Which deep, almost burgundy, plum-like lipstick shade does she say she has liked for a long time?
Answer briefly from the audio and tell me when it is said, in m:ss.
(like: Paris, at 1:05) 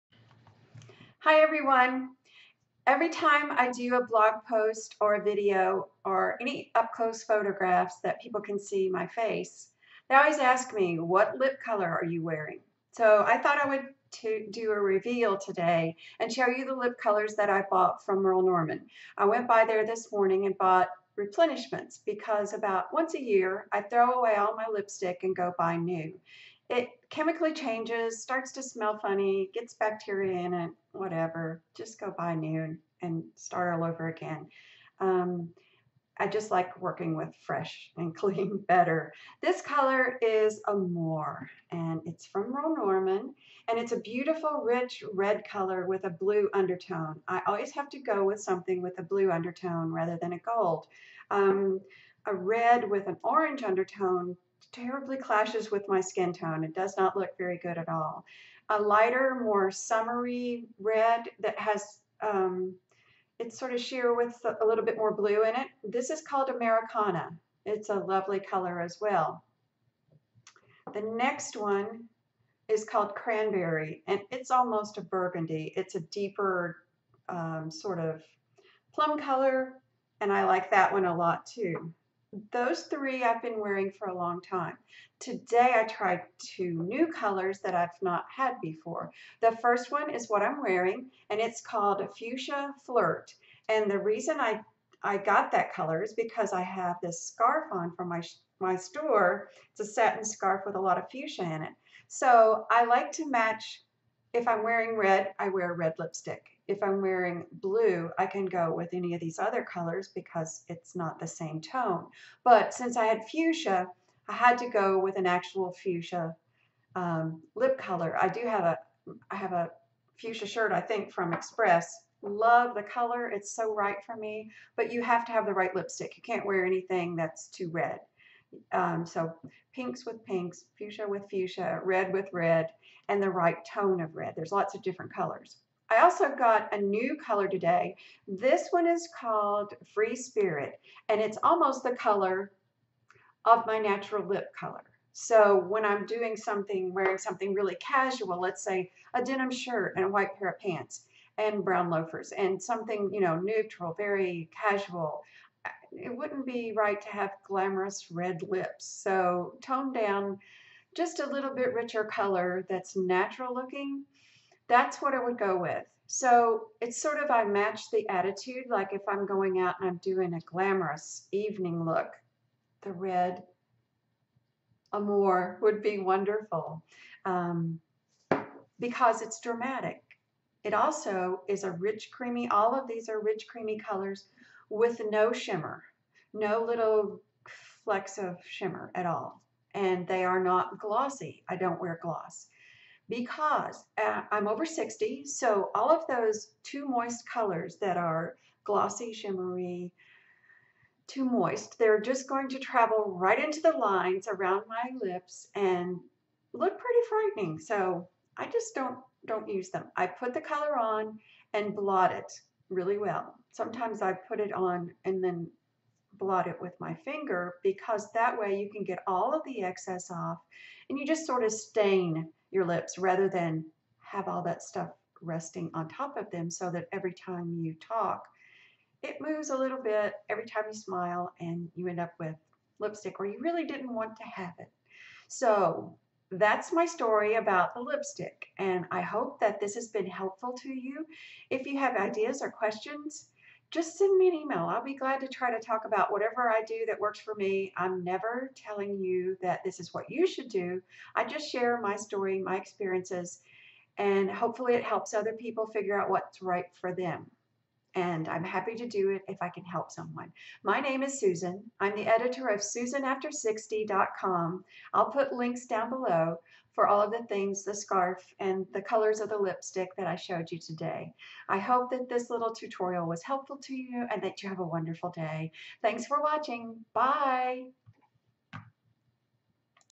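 Cranberry, at 1:13.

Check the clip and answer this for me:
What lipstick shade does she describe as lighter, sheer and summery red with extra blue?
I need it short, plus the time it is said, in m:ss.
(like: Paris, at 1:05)
Americana, at 1:06.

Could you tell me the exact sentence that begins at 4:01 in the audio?
If you have ideas or questions, just send me an email.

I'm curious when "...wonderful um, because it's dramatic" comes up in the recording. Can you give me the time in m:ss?
2:55.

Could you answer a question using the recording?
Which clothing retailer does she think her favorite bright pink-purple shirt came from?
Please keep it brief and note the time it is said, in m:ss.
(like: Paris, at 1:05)
Express, at 2:01.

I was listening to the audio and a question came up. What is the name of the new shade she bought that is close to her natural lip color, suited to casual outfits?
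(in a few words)
Free Spirit.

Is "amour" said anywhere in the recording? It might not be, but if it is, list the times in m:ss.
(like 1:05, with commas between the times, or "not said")
0:40, 2:54.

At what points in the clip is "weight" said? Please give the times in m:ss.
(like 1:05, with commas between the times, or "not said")
not said.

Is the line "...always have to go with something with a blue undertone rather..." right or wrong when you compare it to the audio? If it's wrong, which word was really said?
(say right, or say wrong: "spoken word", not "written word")
right.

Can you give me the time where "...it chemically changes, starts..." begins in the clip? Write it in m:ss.
0:26.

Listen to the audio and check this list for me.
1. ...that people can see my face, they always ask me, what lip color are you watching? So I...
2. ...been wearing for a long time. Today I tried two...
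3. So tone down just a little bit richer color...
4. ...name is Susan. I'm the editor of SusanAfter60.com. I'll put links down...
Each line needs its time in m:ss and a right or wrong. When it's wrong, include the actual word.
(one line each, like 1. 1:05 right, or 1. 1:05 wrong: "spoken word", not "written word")
1. 0:08 wrong: "wearing", not "watching"
2. 1:23 right
3. 2:38 right
4. 4:20 right.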